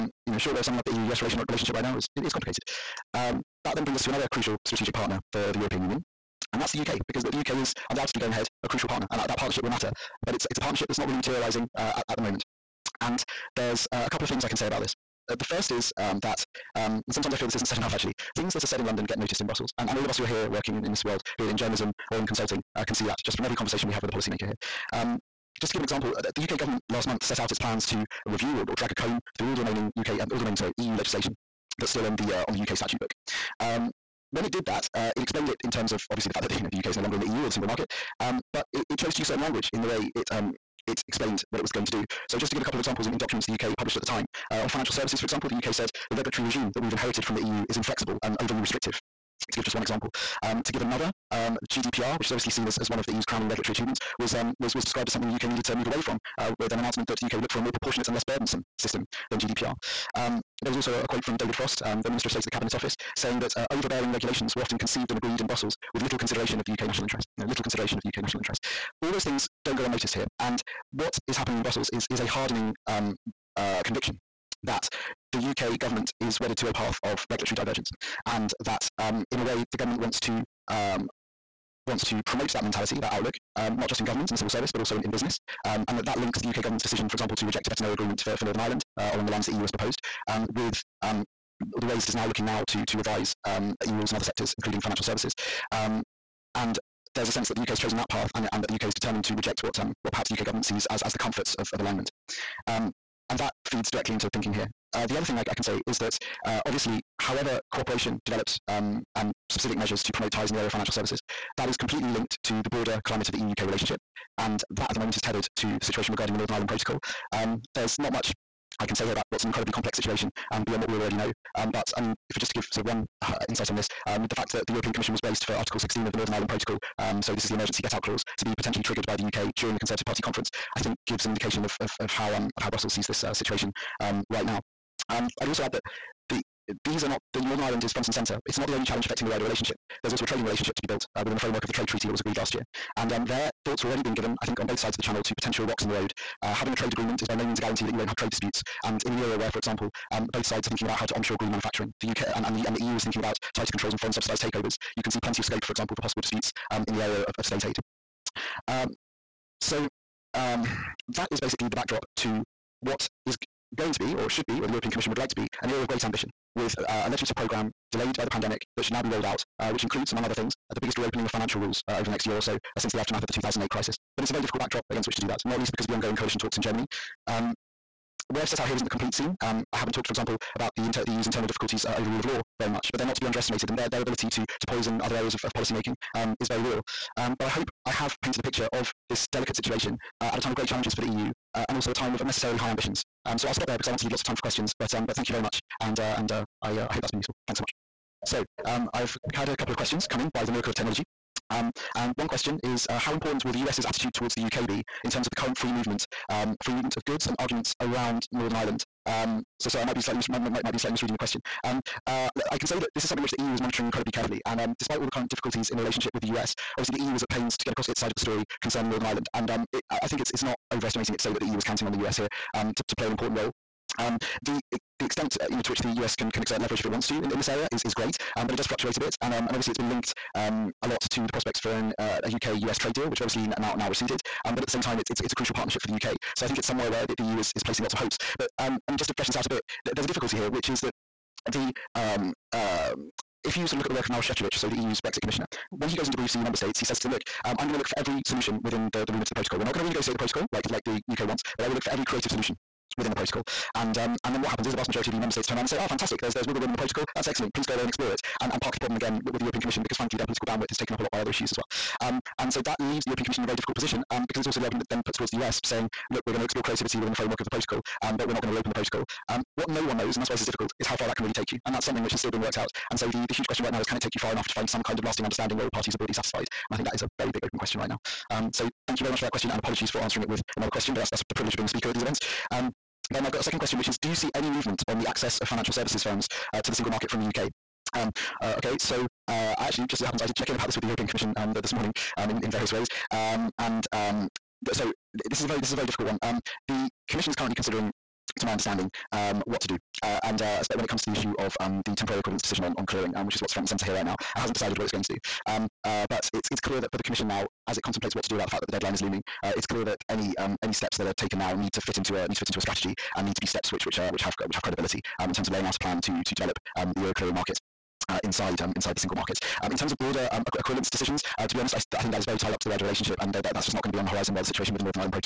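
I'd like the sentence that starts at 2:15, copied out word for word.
Um, I'd also add that the, these are not the Northern Ireland is front and centre.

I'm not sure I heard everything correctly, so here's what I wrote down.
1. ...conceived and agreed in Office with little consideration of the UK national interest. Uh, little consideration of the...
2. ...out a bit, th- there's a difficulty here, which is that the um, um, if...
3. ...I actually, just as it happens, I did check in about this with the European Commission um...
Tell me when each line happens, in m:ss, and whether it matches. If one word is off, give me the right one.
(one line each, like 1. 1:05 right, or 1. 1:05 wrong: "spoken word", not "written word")
1. 1:04 wrong: "Brussels", not "Office"
2. 3:59 right
3. 4:49 right.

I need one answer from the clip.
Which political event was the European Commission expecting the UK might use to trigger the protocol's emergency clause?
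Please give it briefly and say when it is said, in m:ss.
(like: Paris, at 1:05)
Conservative Party conference, at 2:09.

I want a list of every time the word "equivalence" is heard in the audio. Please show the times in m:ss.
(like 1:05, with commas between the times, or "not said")
5:02, 5:20.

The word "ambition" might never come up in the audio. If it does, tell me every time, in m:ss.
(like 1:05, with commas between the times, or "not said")
2:46, 3:12.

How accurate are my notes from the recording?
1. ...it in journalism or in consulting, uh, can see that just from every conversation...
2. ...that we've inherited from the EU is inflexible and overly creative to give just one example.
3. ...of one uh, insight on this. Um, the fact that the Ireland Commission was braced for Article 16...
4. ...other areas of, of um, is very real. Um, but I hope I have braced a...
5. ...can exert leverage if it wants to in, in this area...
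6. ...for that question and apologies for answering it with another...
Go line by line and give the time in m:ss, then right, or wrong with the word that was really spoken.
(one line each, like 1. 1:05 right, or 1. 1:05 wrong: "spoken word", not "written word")
1. 0:21 right
2. 0:46 wrong: "restrictive", not "creative"
3. 2:02 wrong: "European", not "Ireland"
4. 3:05 wrong: "painted", not "braced"
5. 3:46 right
6. 4:39 right.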